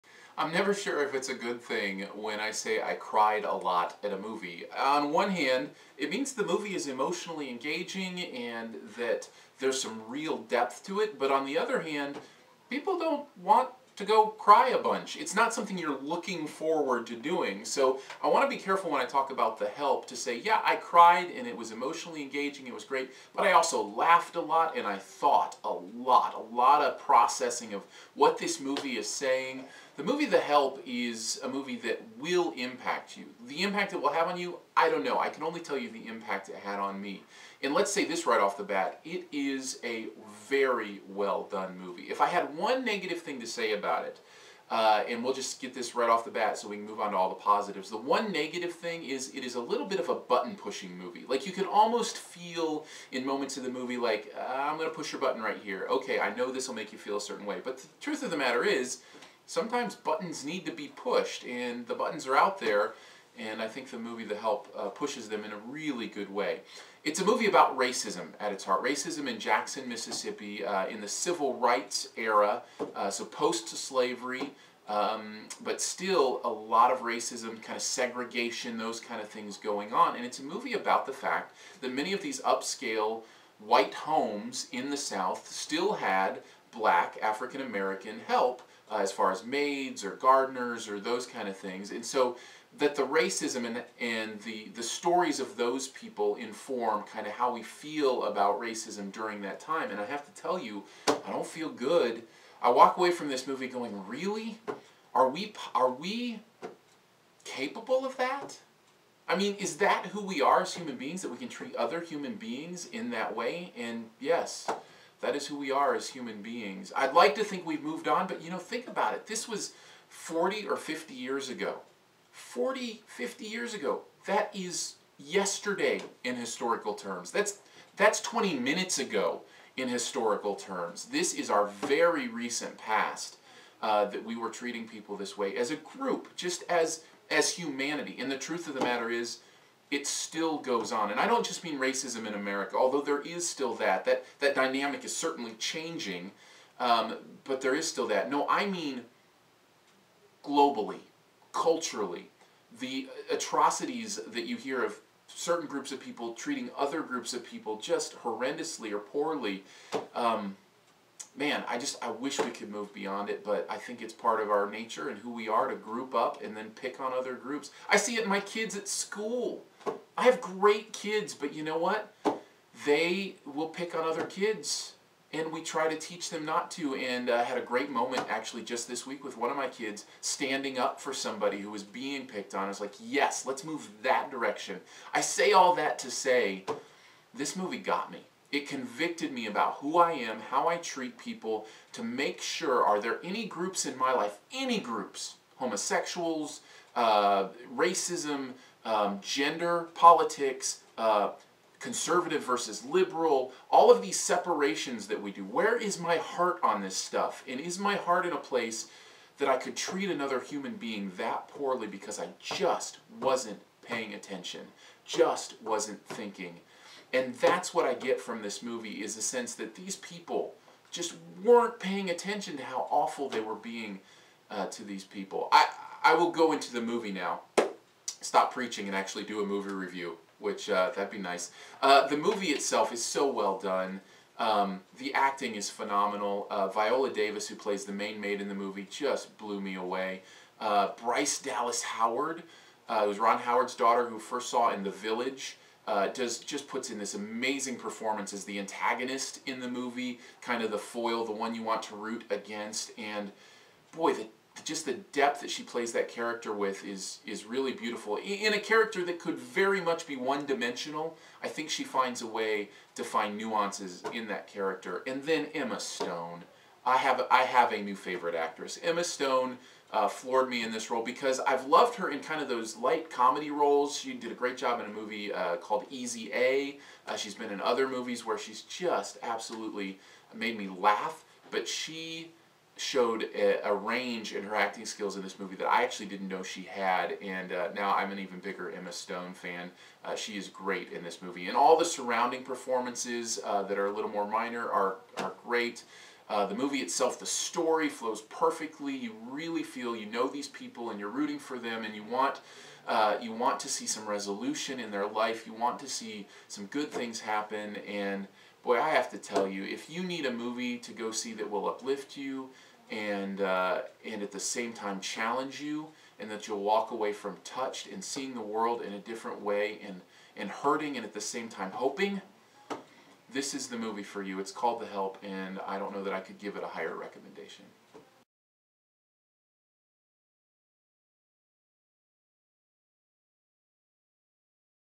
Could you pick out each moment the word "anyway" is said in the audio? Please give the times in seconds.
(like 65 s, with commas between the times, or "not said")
not said.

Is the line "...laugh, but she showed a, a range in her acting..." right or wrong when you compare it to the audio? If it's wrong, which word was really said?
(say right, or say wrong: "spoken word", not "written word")
right.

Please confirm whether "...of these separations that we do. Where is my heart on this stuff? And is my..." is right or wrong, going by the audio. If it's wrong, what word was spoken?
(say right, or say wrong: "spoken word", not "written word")
right.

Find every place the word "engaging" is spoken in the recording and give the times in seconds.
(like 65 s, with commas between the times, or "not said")
7 s, 22 s.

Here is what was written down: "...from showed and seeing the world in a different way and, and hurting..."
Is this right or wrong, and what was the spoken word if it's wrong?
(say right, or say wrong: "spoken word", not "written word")
wrong: "touched", not "showed".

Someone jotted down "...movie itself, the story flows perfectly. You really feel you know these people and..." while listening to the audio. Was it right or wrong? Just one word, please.
right.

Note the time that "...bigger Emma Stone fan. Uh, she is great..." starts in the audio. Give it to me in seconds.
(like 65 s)
288 s.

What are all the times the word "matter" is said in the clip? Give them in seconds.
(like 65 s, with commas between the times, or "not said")
58 s, 138 s.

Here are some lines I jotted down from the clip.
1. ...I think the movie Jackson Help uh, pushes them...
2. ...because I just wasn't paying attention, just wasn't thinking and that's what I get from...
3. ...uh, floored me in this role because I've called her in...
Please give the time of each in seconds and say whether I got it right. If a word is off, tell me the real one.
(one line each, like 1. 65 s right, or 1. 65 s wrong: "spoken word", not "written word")
1. 63 s wrong: "The", not "Jackson"
2. 211 s right
3. 269 s wrong: "loved", not "called".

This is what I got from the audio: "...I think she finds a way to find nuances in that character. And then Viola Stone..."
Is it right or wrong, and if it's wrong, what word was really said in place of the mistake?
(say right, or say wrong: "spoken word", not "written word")
wrong: "Emma", not "Viola".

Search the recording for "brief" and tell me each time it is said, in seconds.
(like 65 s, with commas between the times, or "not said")
not said.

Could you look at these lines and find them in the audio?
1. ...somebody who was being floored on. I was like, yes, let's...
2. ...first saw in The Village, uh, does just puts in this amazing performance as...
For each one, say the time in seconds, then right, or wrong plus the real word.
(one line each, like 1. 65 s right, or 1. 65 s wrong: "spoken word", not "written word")
1. 181 s wrong: "picked", not "floored"
2. 244 s right.